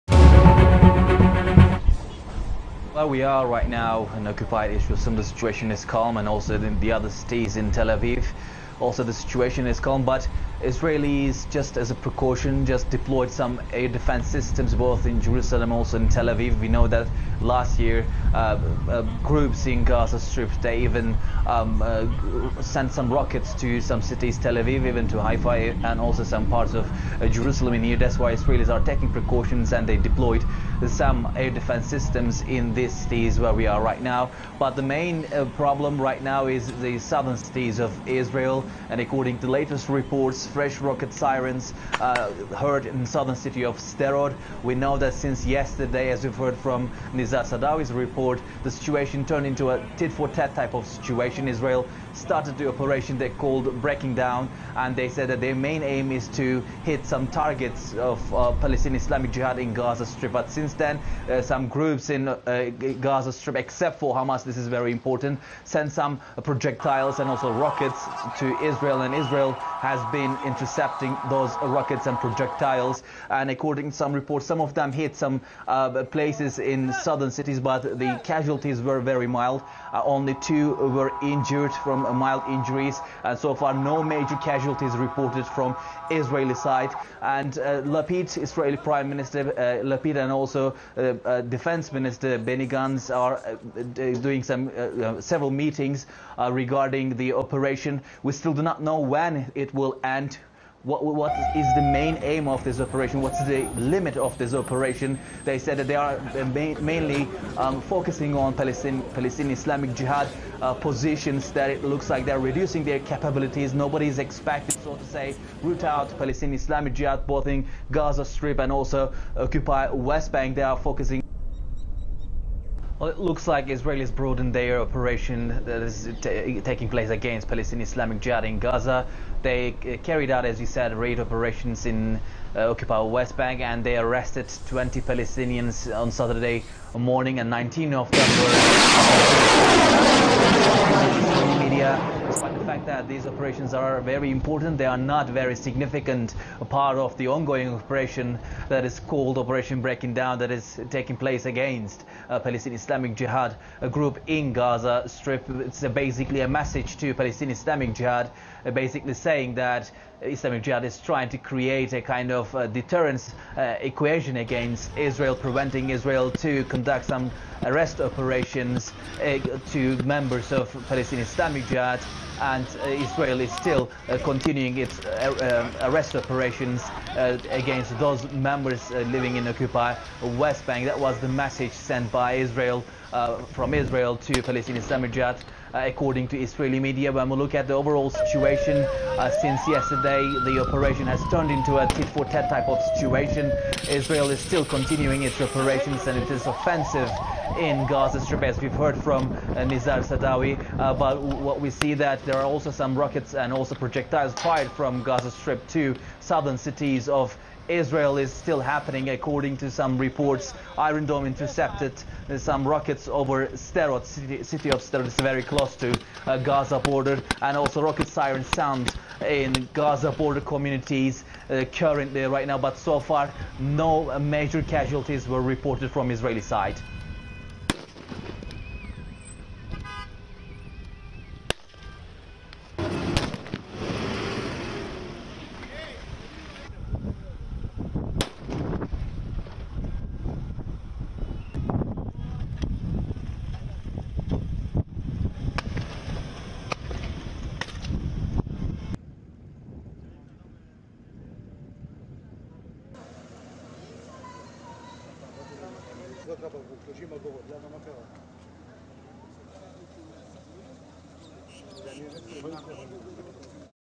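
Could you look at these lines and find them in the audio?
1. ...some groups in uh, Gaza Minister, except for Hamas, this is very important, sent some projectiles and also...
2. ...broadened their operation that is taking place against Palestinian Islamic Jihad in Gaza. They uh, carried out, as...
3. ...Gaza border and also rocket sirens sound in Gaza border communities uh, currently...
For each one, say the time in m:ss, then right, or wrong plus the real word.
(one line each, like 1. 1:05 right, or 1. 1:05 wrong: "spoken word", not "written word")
1. 1:01 wrong: "Strip", not "Minister"
2. 2:04 right
3. 3:36 right.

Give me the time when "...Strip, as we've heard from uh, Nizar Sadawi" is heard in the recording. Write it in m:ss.
3:18.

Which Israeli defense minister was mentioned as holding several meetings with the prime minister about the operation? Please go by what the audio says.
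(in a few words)
Benny Gantz.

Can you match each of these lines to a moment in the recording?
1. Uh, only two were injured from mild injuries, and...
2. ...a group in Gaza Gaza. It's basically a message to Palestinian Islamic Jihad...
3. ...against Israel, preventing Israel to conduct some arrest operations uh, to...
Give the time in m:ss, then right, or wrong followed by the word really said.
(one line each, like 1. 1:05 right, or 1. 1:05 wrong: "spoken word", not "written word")
1. 1:19 right
2. 2:33 wrong: "Strip", not "Gaza"
3. 2:44 right.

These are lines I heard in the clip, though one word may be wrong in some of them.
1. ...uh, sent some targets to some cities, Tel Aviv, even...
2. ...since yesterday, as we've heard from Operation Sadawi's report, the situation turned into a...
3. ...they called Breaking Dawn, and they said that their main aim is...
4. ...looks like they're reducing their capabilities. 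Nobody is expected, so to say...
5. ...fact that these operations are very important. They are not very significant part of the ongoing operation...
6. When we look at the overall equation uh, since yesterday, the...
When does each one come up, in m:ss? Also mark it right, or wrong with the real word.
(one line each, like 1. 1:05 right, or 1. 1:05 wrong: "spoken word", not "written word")
1. 0:21 wrong: "rockets", not "targets"
2. 0:45 wrong: "Nizar", not "Operation"
3. 0:53 right
4. 1:51 right
5. 2:22 right
6. 3:07 wrong: "situation", not "equation".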